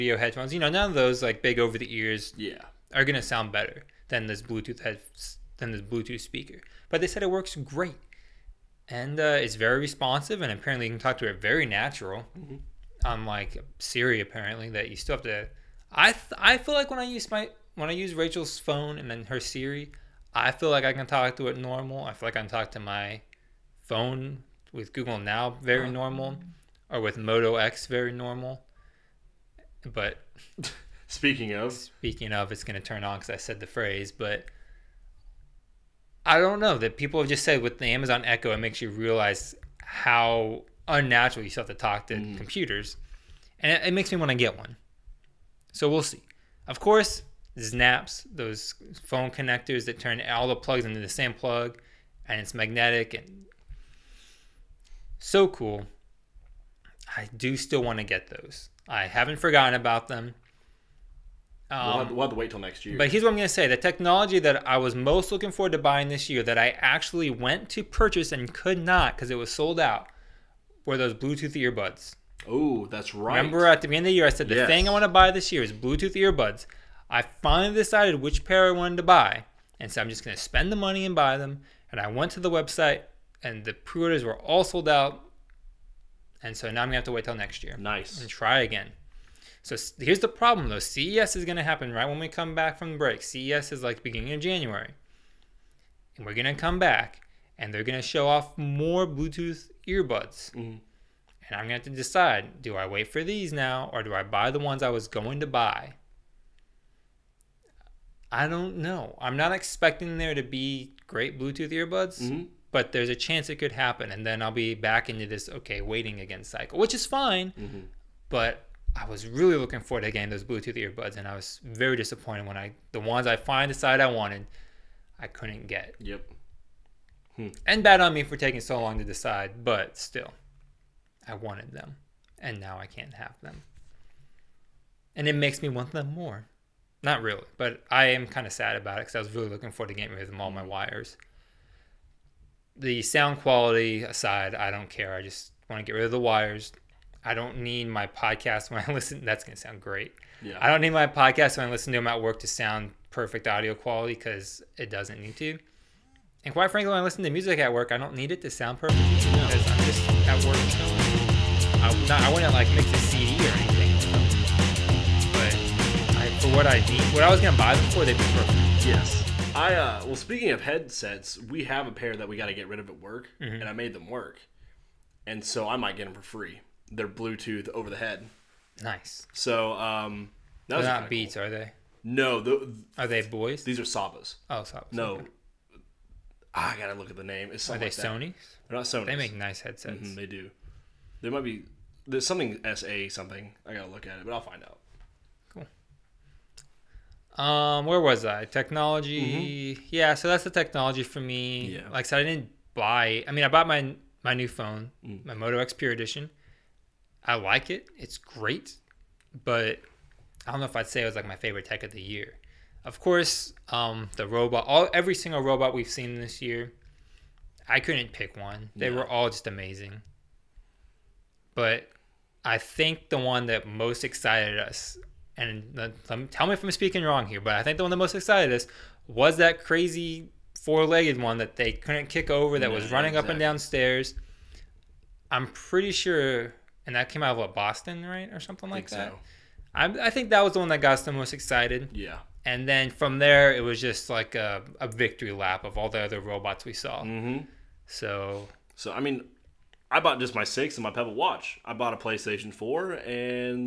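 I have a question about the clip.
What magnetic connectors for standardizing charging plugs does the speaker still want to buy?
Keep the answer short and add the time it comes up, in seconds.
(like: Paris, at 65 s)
Znaps, at 47 s.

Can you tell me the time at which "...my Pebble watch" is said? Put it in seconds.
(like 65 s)
250 s.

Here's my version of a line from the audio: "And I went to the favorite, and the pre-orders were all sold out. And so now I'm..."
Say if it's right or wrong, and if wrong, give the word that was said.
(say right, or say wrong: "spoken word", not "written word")
wrong: "website", not "favorite".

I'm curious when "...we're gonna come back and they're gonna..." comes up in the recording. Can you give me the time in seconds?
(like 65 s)
96 s.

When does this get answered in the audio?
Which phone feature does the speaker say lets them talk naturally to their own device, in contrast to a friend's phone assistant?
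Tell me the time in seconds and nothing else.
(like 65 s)
24 s.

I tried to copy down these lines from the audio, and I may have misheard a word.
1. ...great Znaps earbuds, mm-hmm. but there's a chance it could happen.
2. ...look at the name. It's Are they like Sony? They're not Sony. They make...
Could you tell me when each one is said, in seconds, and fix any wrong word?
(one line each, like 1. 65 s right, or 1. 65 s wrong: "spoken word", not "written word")
1. 111 s wrong: "Bluetooth", not "Znaps"
2. 186 s right.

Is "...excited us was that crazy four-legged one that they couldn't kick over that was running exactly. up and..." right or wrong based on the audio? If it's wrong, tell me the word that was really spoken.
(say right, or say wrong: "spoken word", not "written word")
right.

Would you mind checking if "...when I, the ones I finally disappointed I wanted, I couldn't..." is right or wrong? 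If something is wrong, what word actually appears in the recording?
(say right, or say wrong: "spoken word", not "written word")
wrong: "decided", not "disappointed".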